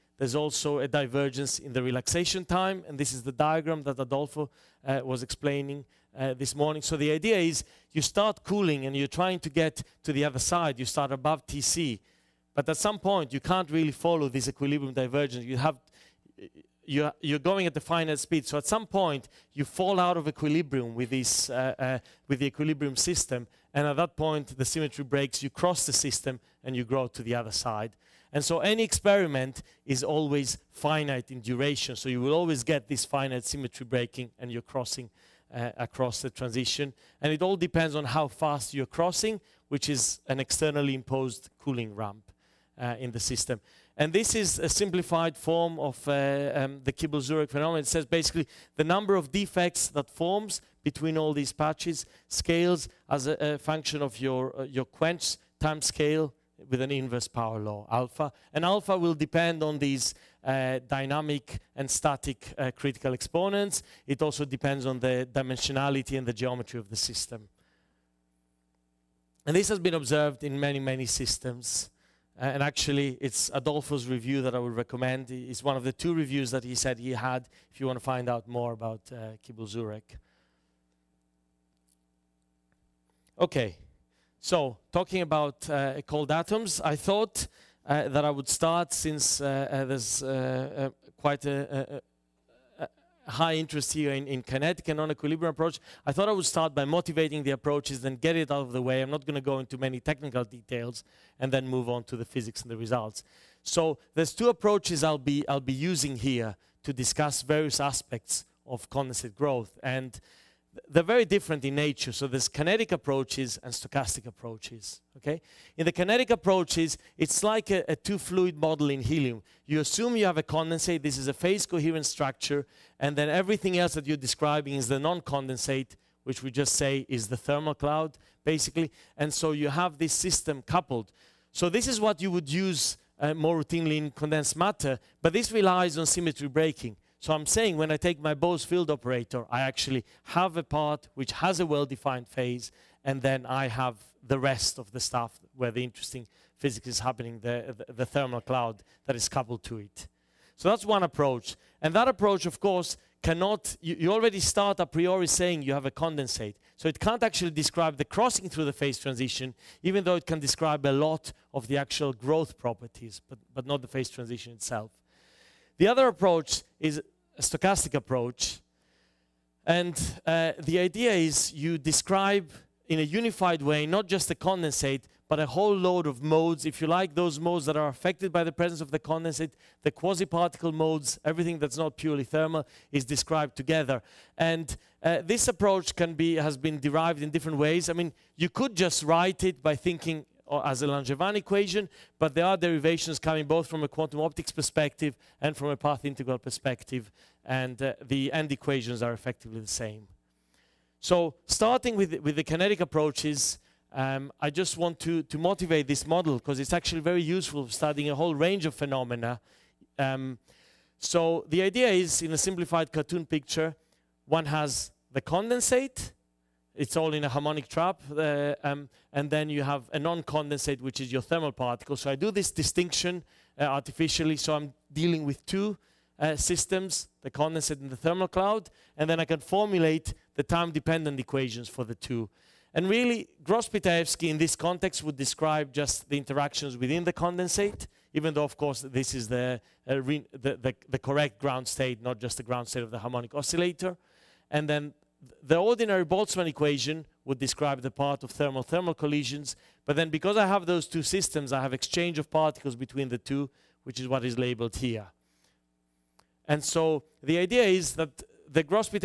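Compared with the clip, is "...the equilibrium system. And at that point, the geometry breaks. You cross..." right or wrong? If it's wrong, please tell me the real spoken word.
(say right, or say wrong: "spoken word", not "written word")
wrong: "symmetry", not "geometry".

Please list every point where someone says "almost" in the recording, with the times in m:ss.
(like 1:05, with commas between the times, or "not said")
not said.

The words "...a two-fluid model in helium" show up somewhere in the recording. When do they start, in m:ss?
1:57.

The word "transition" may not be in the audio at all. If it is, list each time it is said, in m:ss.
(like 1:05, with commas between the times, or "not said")
0:36, 2:38, 2:44.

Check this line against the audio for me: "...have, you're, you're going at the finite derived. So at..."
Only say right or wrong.
wrong.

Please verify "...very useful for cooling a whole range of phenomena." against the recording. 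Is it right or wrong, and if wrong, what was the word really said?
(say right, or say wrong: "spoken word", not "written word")
wrong: "studying", not "cooling".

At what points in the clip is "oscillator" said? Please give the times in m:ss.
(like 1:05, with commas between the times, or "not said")
4:03.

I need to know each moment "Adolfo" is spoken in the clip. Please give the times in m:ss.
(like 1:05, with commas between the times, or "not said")
0:03, 1:13.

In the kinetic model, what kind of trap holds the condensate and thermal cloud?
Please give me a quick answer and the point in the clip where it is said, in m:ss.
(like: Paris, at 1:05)
harmonic trap, at 3:37.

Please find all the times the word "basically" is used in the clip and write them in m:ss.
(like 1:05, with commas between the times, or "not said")
0:48, 2:08.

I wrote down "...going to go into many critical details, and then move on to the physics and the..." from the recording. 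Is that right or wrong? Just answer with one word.
wrong.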